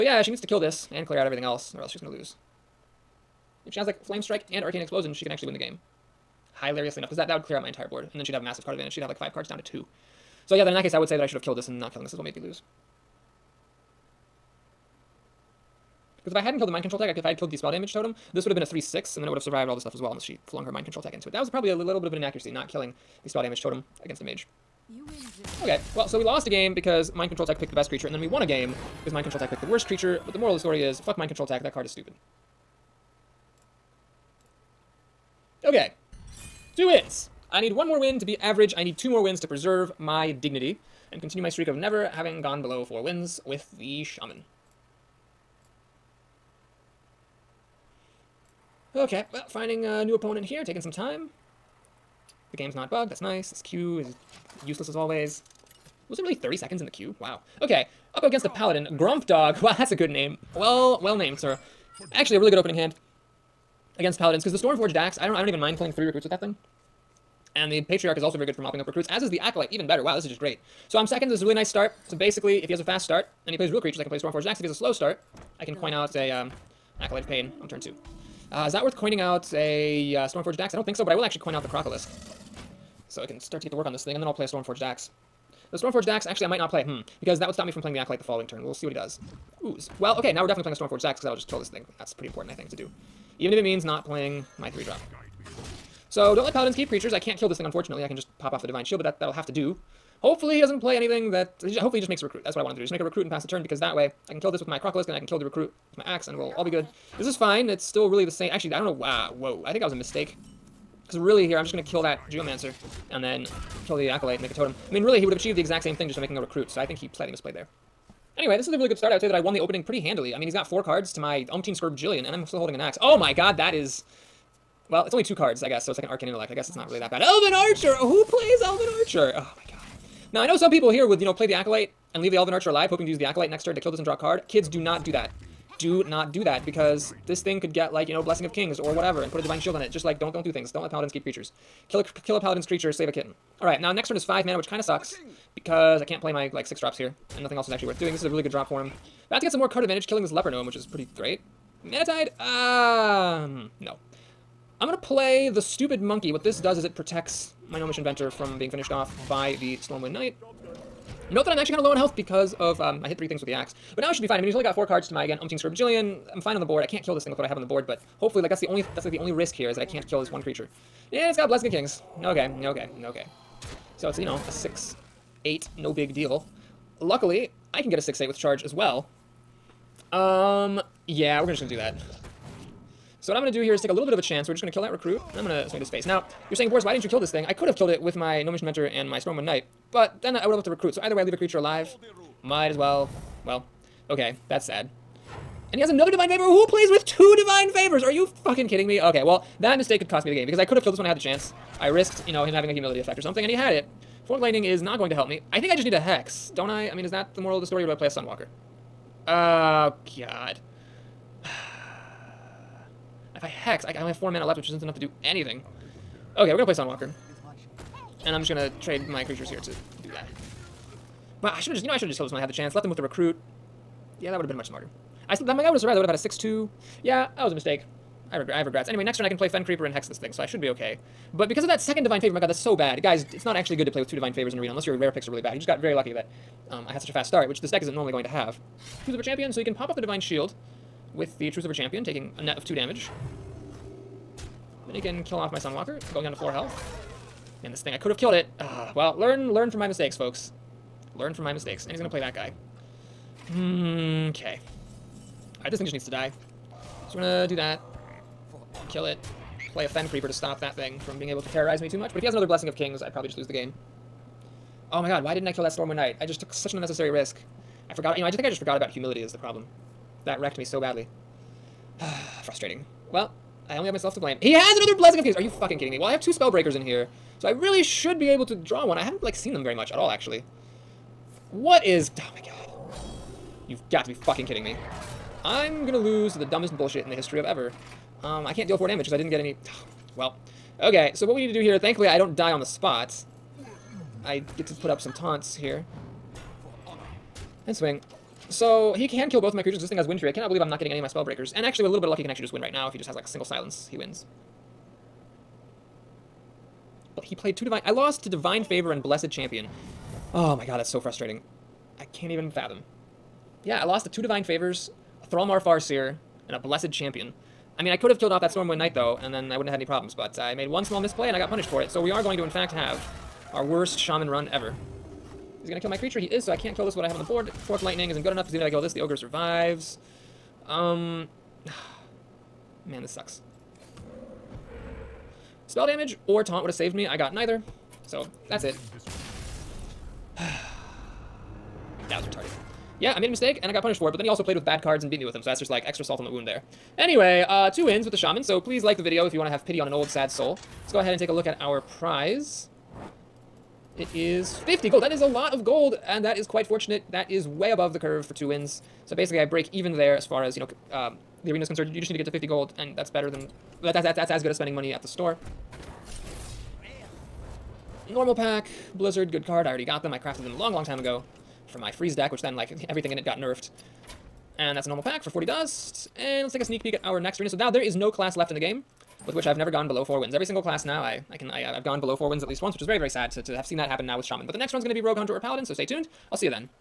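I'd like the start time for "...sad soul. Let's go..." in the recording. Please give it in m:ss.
5:50.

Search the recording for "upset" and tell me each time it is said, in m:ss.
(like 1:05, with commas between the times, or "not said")
not said.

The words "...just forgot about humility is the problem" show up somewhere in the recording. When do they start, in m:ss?
4:28.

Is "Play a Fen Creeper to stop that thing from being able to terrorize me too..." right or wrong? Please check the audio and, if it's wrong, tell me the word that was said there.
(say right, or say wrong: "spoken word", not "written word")
right.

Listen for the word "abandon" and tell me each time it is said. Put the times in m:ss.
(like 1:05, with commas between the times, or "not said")
not said.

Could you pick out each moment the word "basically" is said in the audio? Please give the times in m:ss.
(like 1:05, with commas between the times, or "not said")
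1:12, 5:59.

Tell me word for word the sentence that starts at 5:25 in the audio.
He's gonna kill my creature, he is, so I can't kill this with what I have on the board.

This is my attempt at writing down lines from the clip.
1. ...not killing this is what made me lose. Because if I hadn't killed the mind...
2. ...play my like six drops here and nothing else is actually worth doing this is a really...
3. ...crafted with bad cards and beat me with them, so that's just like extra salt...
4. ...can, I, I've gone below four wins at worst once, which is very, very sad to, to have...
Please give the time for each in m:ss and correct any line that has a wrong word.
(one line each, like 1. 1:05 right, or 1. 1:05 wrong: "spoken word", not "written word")
1. 0:11 right
2. 2:26 right
3. 5:44 wrong: "played", not "crafted"
4. 6:21 wrong: "least", not "worst".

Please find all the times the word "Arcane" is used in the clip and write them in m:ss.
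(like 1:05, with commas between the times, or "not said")
0:04, 2:06.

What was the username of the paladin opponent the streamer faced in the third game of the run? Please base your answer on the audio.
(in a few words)
Grump Dog.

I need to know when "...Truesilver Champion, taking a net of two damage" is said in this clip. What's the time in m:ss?
4:01.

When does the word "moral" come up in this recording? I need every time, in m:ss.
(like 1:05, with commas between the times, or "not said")
0:30, 3:27.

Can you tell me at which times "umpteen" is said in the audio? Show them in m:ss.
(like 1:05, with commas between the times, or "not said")
2:01, 2:45.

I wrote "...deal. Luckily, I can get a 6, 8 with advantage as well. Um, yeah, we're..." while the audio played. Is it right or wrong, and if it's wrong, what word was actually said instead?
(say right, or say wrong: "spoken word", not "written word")
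wrong: "charge", not "advantage".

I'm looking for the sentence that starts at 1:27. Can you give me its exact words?
Because that would stop me from playing the Acolyte the following turn.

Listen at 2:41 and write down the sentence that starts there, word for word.
Note that I'm actually kind of low on health because of, um, I hit three things with the axe.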